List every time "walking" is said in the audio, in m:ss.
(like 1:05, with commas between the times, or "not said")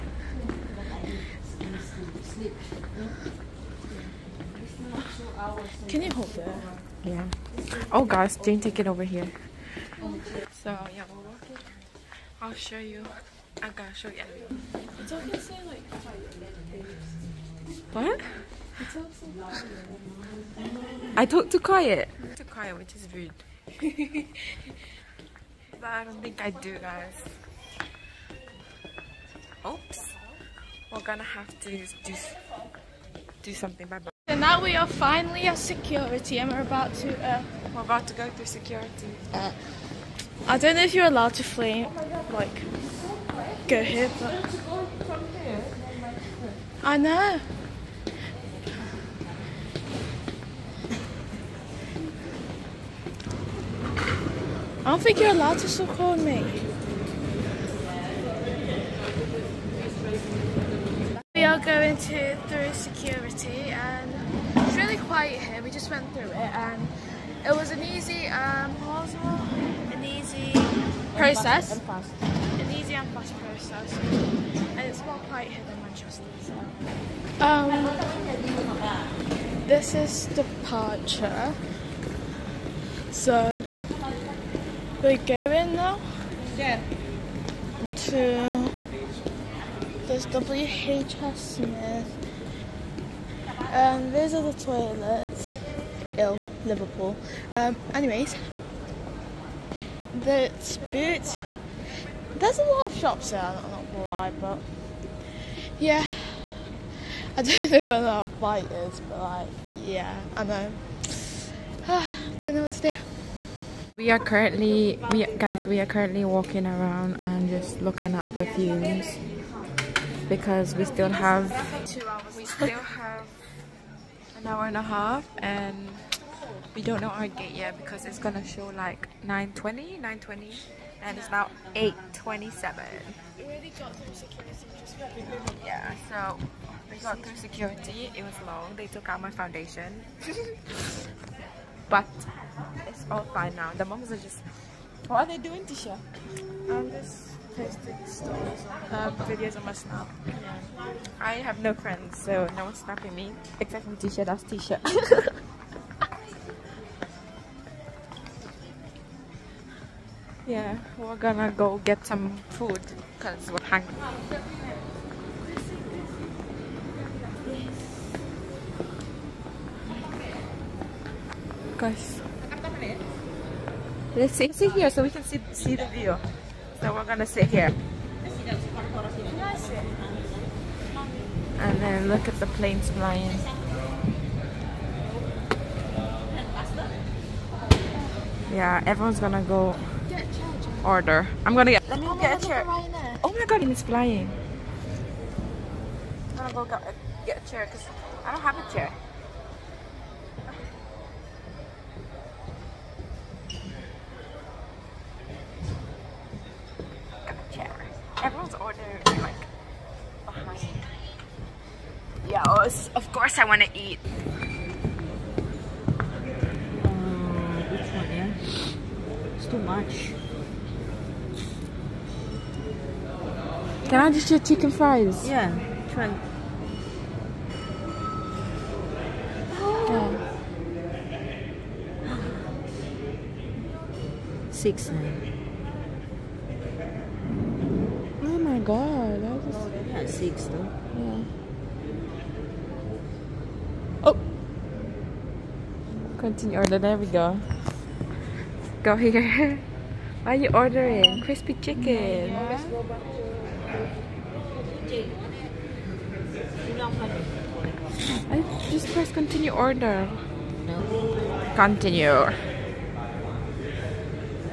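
0:11, 1:56.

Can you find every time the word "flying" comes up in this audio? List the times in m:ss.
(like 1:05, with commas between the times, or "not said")
3:02, 3:13.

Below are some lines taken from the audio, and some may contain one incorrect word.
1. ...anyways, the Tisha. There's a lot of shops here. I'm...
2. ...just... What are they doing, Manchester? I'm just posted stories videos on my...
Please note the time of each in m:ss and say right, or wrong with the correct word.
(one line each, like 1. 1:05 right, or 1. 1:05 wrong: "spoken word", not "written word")
1. 1:37 wrong: "Boots", not "Tisha"
2. 2:24 wrong: "Tisha", not "Manchester".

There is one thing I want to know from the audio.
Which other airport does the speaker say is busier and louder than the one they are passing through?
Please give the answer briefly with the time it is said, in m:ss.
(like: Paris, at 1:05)
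Manchester, at 1:15.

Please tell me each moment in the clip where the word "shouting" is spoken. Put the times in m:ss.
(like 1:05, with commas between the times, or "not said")
not said.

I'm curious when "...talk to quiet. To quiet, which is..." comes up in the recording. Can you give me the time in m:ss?
0:21.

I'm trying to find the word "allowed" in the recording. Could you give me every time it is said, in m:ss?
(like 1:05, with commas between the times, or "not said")
0:41, 0:55.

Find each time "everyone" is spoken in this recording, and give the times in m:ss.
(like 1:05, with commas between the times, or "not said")
0:14, 3:08.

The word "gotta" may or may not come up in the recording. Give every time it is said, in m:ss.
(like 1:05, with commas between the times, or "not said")
0:13.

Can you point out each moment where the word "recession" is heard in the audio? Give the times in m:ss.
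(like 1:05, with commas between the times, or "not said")
not said.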